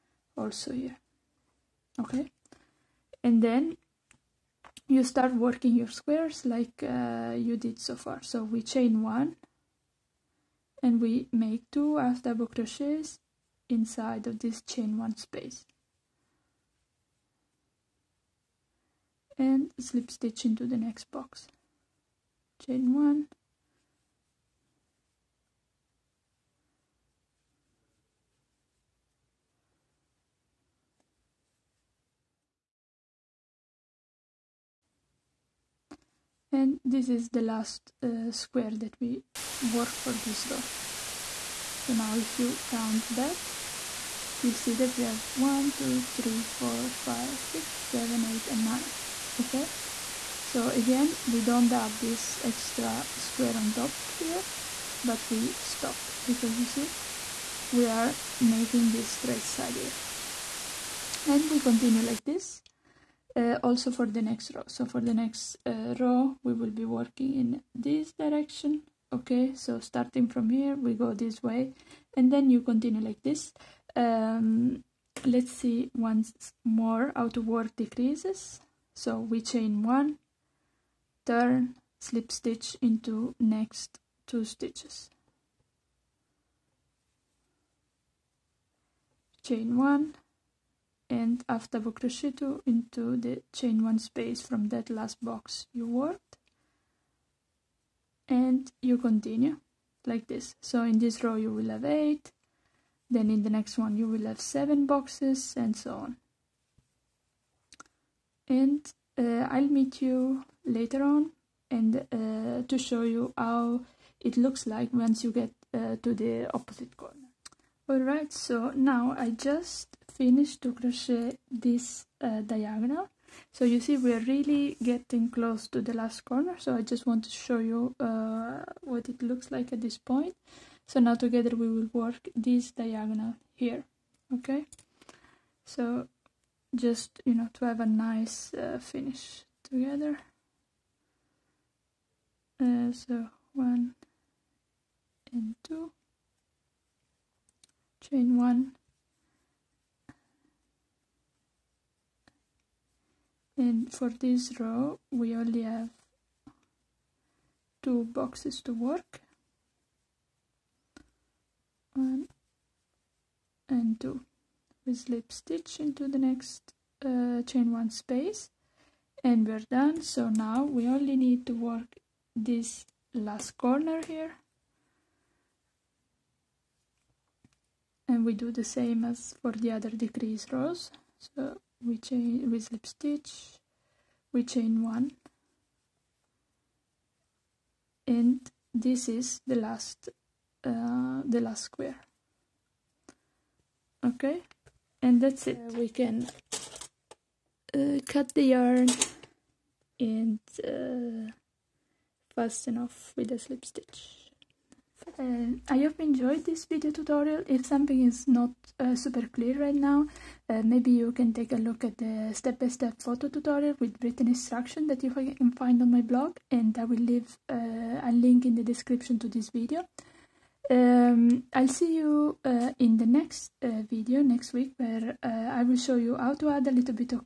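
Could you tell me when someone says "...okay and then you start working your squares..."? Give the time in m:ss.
0:02.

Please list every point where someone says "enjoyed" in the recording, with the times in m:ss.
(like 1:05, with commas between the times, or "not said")
3:26.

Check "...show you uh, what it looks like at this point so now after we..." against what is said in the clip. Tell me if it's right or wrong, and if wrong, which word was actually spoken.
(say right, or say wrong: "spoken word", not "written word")
wrong: "together", not "after".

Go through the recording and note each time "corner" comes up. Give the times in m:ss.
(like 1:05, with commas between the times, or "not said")
1:56, 2:06, 2:53.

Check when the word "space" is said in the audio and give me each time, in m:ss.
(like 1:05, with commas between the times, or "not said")
0:15, 1:33, 2:47.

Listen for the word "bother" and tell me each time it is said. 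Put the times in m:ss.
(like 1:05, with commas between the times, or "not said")
not said.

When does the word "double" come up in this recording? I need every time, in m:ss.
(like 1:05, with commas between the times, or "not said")
0:12.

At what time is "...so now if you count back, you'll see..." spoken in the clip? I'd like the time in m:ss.
0:41.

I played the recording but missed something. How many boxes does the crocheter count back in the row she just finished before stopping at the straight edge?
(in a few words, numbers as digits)
9.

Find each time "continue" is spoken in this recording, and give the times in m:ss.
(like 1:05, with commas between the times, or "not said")
1:01, 1:12, 1:38.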